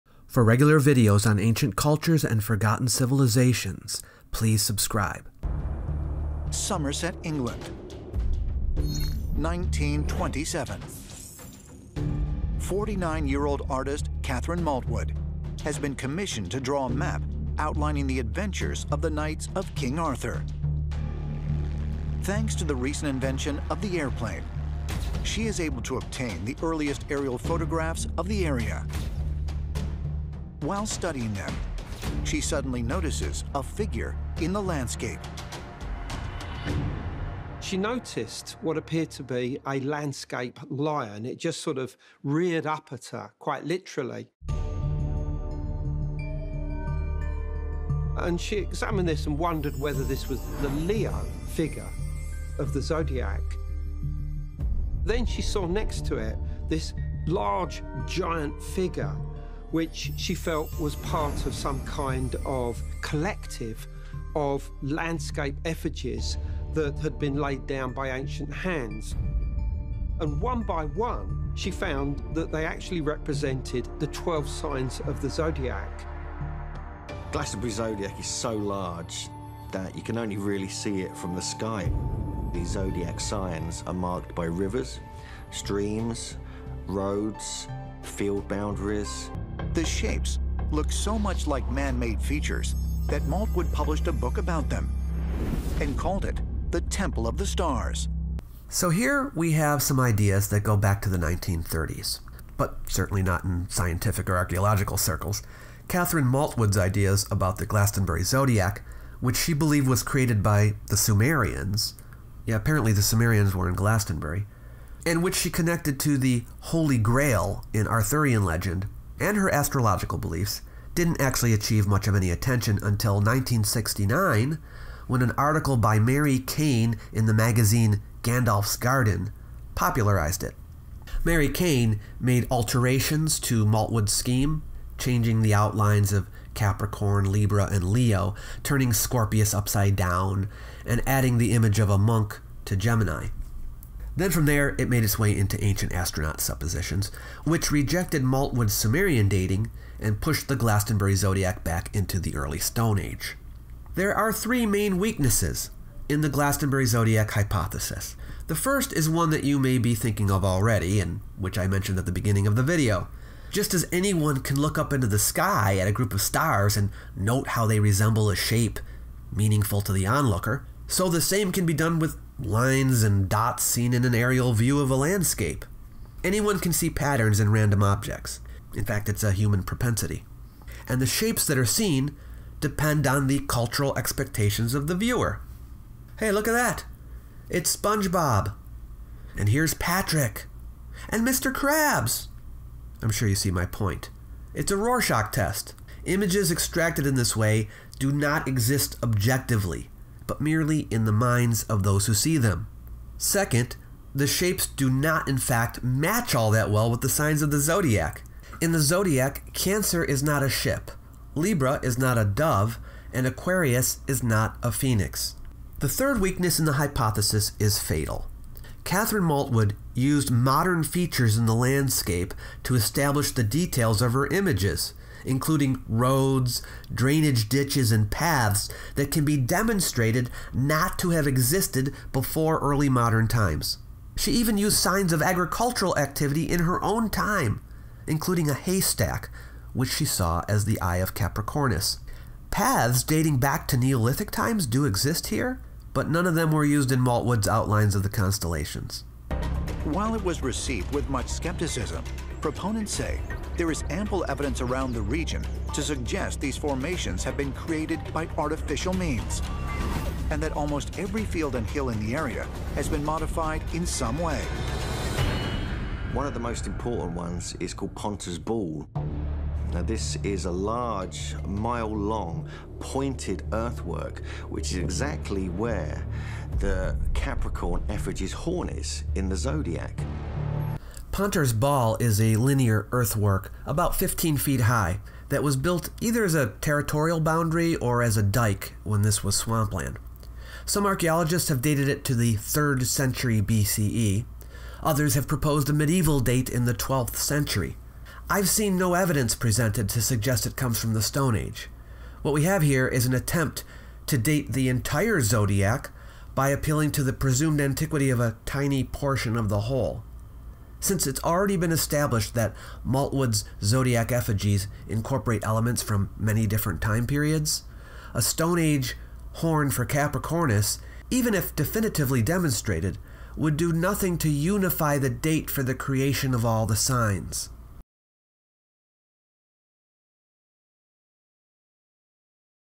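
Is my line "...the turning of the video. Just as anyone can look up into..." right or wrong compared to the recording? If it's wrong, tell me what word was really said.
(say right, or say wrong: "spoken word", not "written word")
wrong: "beginning", not "turning".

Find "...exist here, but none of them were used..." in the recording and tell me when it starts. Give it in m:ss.
4:04.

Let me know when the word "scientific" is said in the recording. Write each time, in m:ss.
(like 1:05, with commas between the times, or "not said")
1:43.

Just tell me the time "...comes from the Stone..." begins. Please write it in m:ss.
5:00.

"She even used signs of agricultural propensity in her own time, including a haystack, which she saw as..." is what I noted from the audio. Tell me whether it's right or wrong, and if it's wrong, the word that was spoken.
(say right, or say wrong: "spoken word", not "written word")
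wrong: "activity", not "propensity".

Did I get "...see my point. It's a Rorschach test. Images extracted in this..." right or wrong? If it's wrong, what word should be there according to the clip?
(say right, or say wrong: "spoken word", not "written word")
right.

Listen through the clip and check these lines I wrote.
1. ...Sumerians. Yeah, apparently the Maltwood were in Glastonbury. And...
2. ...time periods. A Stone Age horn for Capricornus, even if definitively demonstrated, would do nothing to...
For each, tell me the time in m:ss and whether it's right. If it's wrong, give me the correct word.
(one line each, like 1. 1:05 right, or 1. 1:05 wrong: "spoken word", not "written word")
1. 1:50 wrong: "Sumerians", not "Maltwood"
2. 5:16 right.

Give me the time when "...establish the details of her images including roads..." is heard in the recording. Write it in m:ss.
3:42.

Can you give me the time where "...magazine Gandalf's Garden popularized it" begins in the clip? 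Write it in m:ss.
2:07.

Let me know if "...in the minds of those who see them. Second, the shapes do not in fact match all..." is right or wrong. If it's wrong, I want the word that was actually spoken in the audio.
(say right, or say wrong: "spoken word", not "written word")
right.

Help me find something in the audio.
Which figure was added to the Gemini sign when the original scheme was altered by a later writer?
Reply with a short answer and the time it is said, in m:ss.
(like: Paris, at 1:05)
a monk, at 2:21.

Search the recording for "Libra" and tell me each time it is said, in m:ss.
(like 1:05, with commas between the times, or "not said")
2:17, 3:31.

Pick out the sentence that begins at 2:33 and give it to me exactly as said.
There are three main weaknesses in the Glastonbury zodiac hypothesis.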